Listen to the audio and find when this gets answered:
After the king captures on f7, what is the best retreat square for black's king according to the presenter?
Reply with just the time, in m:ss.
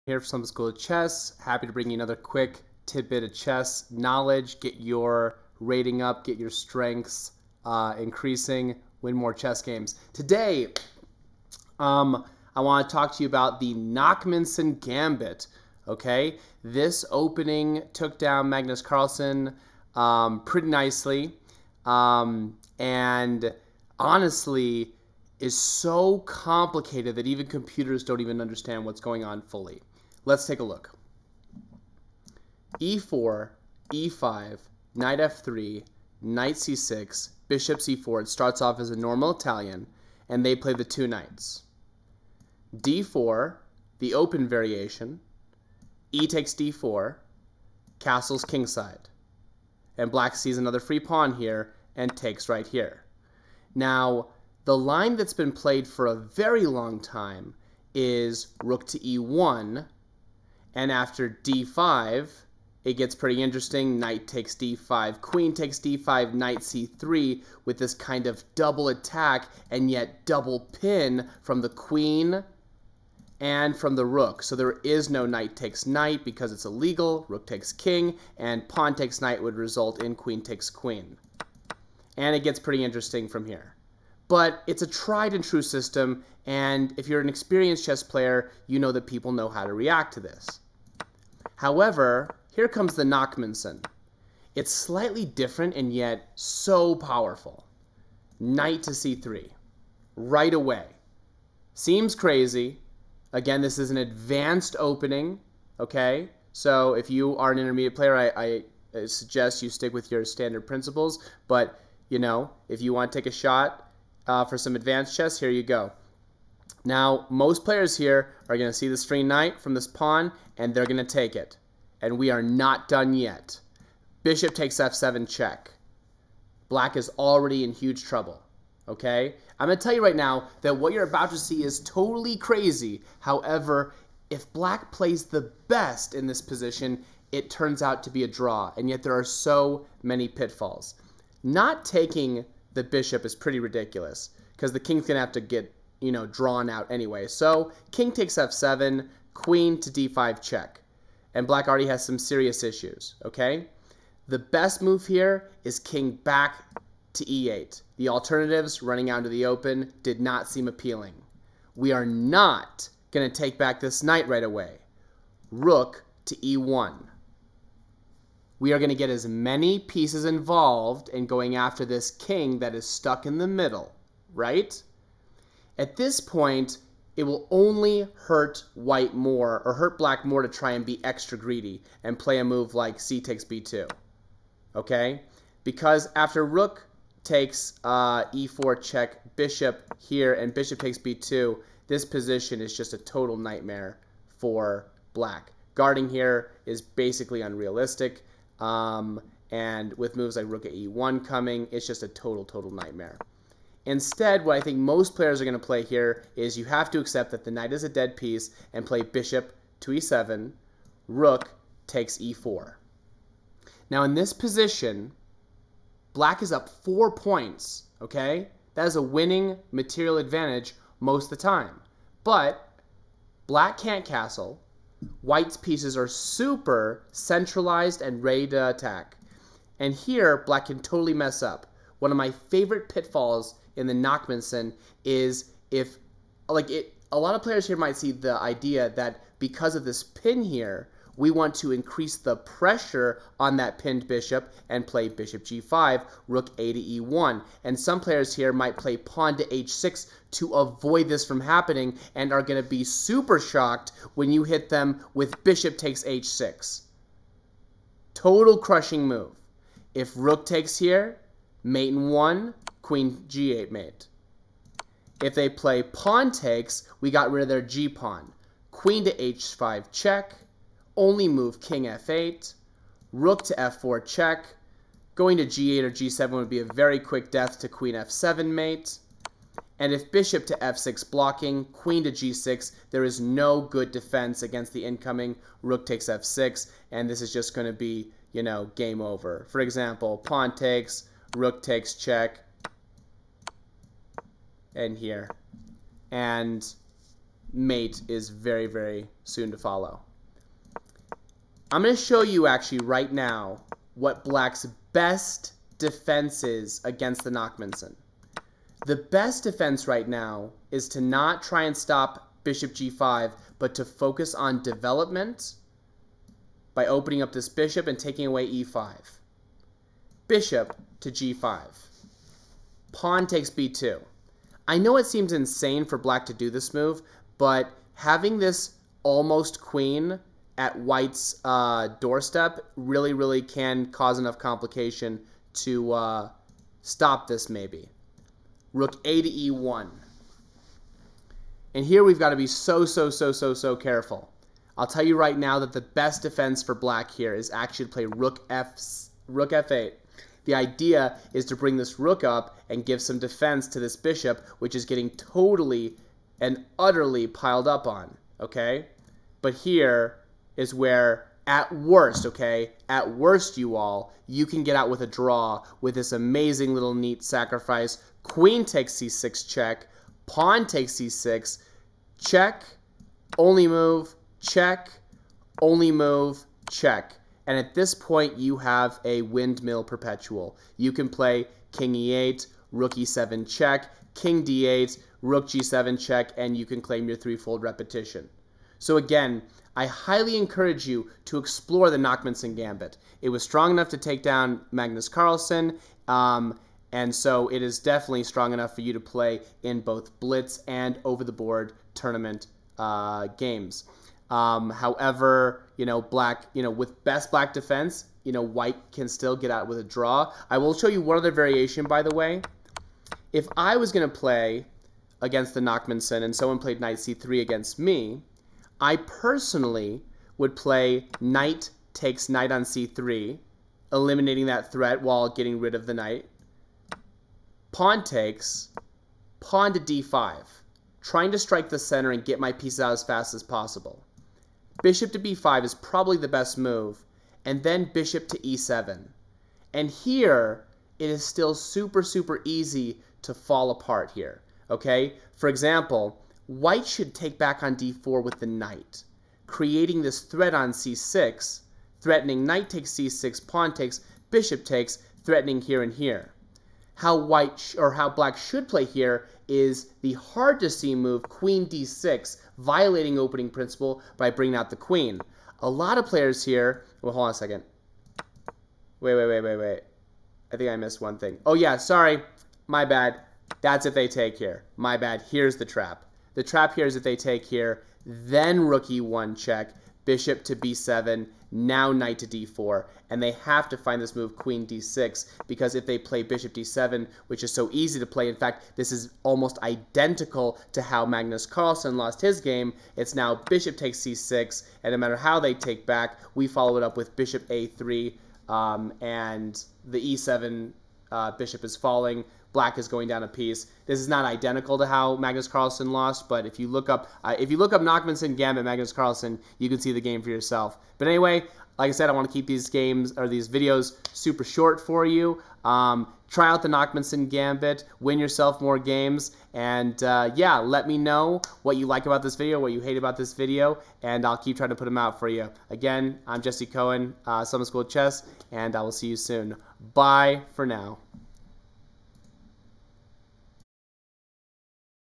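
2:35.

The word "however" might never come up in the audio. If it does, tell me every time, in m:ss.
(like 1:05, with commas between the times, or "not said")
1:31, 2:13, 6:44.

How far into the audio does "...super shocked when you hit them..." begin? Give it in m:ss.
4:12.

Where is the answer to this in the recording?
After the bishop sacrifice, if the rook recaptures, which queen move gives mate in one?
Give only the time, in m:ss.
4:22.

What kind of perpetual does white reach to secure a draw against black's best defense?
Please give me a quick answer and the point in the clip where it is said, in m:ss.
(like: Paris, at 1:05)
Windmill perpetual, at 6:19.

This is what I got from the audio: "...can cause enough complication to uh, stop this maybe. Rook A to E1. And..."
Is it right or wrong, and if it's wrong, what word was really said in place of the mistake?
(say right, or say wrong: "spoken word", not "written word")
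right.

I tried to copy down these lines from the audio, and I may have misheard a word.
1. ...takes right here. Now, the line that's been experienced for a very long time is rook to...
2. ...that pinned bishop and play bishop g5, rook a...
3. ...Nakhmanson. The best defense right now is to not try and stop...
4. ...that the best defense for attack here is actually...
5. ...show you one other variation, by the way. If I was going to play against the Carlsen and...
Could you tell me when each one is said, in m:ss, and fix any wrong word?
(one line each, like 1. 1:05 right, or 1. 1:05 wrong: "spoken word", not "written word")
1. 0:52 wrong: "played", not "experienced"
2. 4:03 right
3. 5:07 right
4. 5:45 wrong: "black", not "attack"
5. 6:50 wrong: "Nakhmanson", not "Carlsen".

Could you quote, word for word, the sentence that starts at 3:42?
But black can't castle, White's pieces are super centralized and ready to attack.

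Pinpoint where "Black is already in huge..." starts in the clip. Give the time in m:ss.
2:06.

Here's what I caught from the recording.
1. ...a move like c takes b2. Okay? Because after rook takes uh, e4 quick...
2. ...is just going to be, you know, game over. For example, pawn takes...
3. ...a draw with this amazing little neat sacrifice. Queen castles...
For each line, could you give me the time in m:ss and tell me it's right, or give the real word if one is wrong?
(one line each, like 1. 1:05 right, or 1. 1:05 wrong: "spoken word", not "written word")
1. 3:02 wrong: "check", not "quick"
2. 4:47 right
3. 6:05 wrong: "takes", not "castles".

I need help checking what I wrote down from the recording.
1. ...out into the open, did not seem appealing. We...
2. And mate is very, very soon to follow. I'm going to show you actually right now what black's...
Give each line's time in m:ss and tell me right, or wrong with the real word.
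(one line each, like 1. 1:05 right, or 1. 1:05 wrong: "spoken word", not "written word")
1. 2:39 right
2. 4:56 right.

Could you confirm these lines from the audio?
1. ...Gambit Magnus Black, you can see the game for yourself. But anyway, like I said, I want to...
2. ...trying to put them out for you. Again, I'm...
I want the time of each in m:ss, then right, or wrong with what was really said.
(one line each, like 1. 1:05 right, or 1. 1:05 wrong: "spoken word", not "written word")
1. 8:28 wrong: "Carlsen", not "Black"
2. 8:44 right.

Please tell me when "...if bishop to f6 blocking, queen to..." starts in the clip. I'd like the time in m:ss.
4:39.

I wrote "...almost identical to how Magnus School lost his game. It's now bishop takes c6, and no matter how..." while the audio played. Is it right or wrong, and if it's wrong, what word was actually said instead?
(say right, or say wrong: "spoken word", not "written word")
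wrong: "Carlsen", not "School".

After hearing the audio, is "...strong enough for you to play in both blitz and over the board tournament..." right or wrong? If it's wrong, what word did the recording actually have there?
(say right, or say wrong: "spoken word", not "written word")
right.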